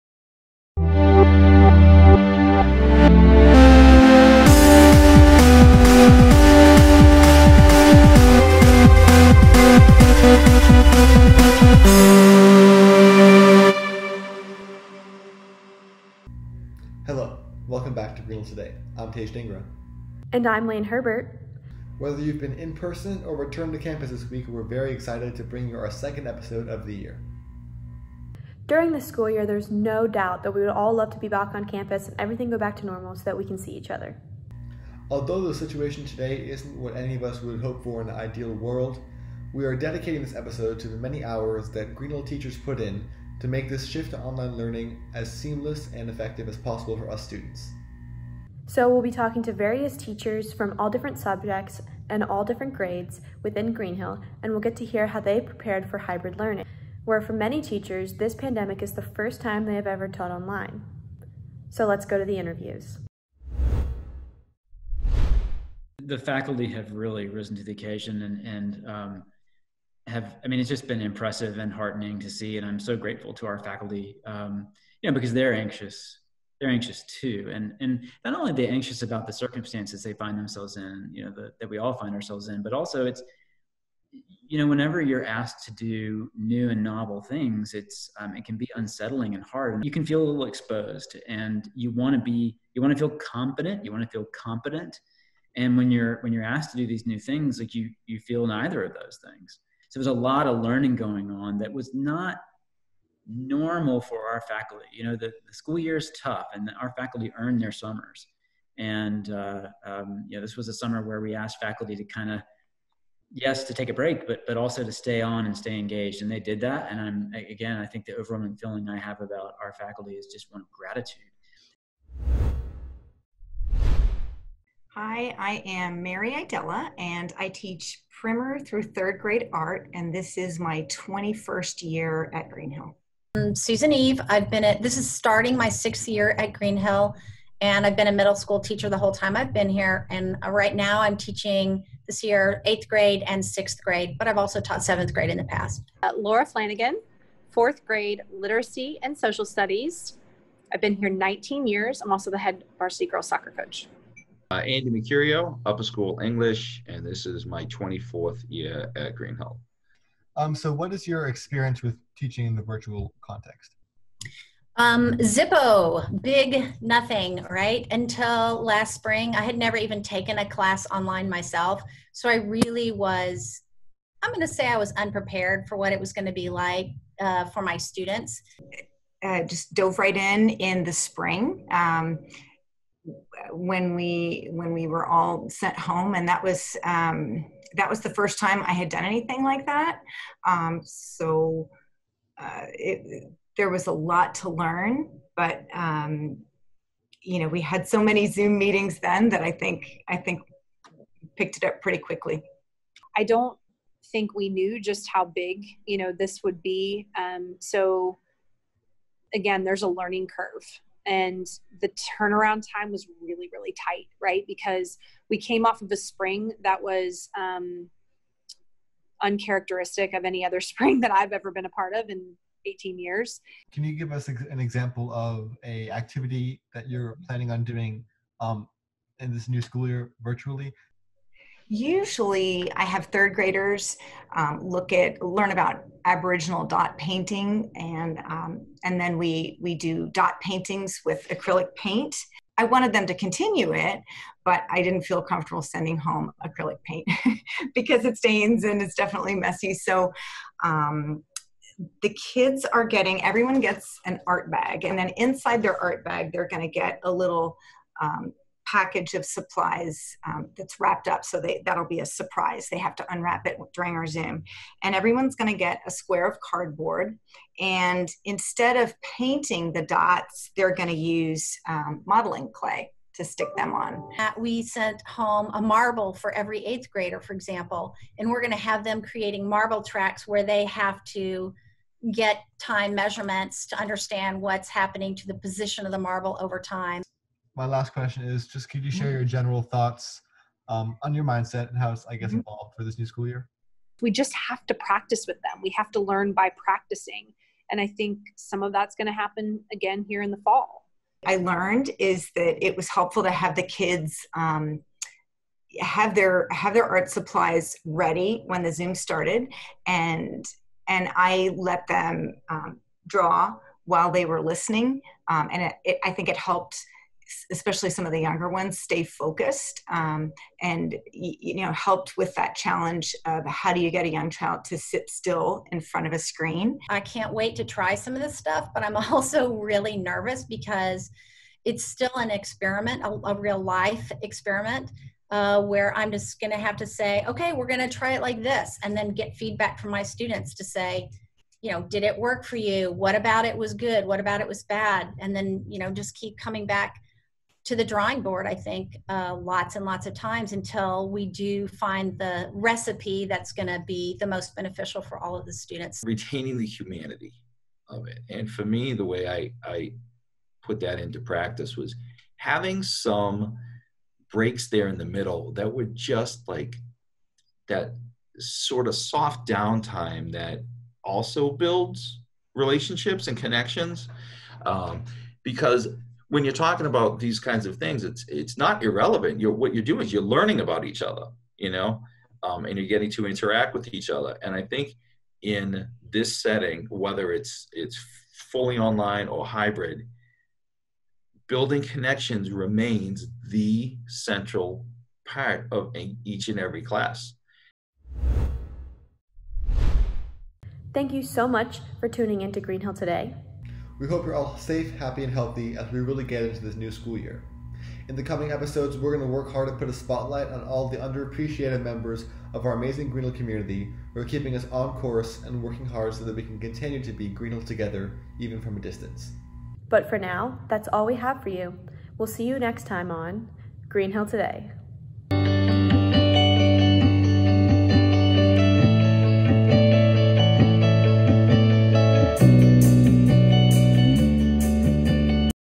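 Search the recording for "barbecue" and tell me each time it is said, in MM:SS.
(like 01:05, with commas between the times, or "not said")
not said.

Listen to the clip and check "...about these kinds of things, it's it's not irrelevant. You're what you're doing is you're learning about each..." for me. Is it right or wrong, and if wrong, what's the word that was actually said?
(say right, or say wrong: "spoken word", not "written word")
right.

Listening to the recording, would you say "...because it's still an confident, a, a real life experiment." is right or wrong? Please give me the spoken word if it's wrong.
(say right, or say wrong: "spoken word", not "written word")
wrong: "experiment", not "confident".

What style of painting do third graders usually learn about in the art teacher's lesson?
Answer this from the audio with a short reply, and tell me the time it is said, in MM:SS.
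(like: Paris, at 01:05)
Aboriginal dot painting, at 03:56.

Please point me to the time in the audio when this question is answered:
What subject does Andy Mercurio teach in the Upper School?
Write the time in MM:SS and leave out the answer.
02:36.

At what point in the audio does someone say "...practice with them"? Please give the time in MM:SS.
04:54.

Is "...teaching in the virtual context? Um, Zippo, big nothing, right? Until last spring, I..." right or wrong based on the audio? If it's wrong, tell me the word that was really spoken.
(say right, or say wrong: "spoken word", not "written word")
right.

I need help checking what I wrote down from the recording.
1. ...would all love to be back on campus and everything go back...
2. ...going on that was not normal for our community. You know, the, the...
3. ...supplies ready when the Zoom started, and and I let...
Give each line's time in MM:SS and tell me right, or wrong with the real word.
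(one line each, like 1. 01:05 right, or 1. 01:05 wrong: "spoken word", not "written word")
1. 00:30 right
2. 01:40 wrong: "faculty", not "community"
3. 05:07 right.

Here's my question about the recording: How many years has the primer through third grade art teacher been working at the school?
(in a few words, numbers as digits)
21.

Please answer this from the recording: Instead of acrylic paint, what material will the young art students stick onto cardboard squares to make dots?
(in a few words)
Modeling clay.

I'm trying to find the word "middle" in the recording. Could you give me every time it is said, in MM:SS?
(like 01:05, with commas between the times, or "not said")
02:18, 06:05.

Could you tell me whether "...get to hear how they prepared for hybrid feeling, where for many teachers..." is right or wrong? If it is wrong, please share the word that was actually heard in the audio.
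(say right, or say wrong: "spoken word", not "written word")
wrong: "learning", not "feeling".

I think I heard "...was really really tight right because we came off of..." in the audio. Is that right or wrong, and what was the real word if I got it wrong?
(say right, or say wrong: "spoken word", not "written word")
right.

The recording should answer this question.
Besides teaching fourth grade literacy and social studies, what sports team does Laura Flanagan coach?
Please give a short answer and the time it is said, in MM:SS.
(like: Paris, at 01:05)
Varsity girls soccer, at 02:32.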